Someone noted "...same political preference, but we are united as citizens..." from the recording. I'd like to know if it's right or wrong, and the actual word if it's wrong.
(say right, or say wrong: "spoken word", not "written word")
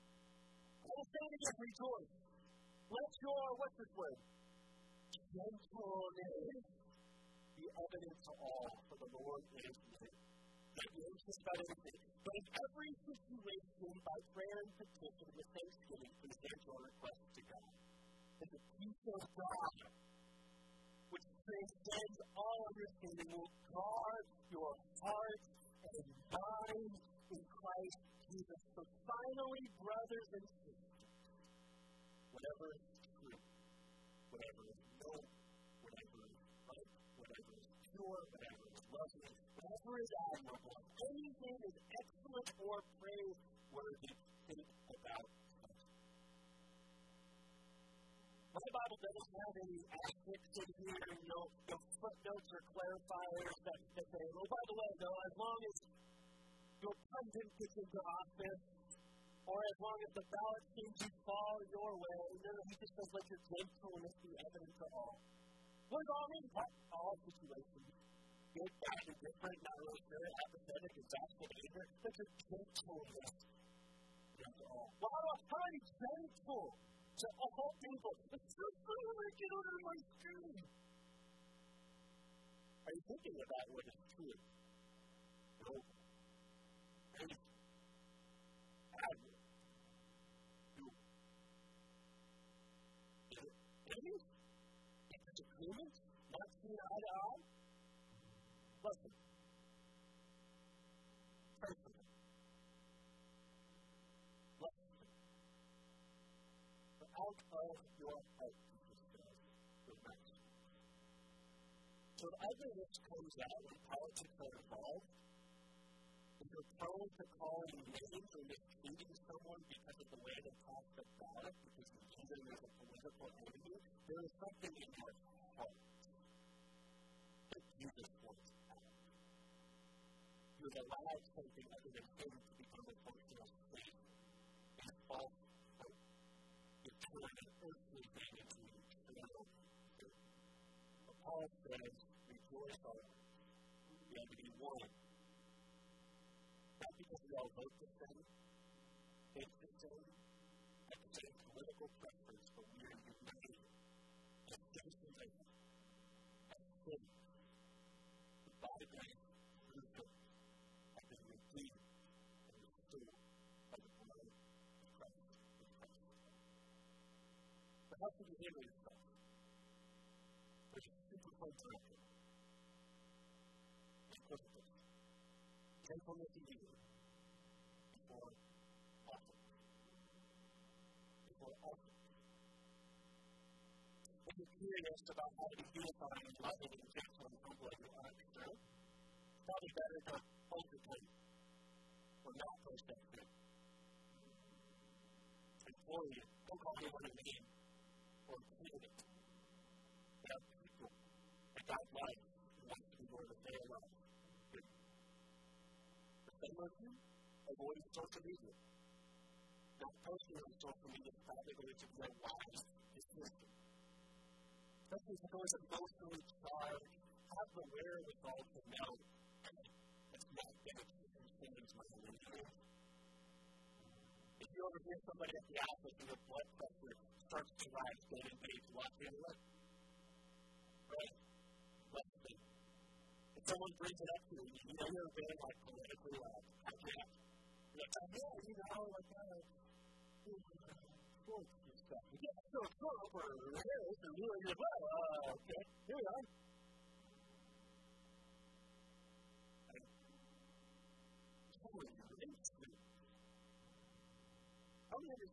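right.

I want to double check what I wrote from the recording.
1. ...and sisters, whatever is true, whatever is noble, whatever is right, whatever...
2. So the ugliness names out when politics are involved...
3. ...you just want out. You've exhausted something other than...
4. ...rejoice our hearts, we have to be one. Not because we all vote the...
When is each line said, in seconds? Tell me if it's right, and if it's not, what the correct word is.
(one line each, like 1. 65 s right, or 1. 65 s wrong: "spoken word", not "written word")
1. 30 s right
2. 112 s wrong: "comes", not "names"
3. 127 s wrong: "allowed", not "exhausted"
4. 142 s right.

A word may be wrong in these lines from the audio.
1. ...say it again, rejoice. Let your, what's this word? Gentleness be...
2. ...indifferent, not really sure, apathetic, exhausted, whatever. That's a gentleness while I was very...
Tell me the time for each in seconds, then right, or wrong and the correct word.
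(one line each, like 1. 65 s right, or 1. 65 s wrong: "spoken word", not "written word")
1. 1 s right
2. 69 s wrong: "anger", not "whatever".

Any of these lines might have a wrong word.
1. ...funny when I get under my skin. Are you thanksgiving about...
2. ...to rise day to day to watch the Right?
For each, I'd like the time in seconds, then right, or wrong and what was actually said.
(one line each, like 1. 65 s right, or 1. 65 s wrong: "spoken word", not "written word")
1. 78 s wrong: "thinking", not "thanksgiving"
2. 227 s right.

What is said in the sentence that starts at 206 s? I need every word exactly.
The same as you, avoid social media.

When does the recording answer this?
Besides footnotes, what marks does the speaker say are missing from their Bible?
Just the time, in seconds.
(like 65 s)
49 s.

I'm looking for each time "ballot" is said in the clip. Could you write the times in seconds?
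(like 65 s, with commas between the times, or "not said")
60 s, 121 s.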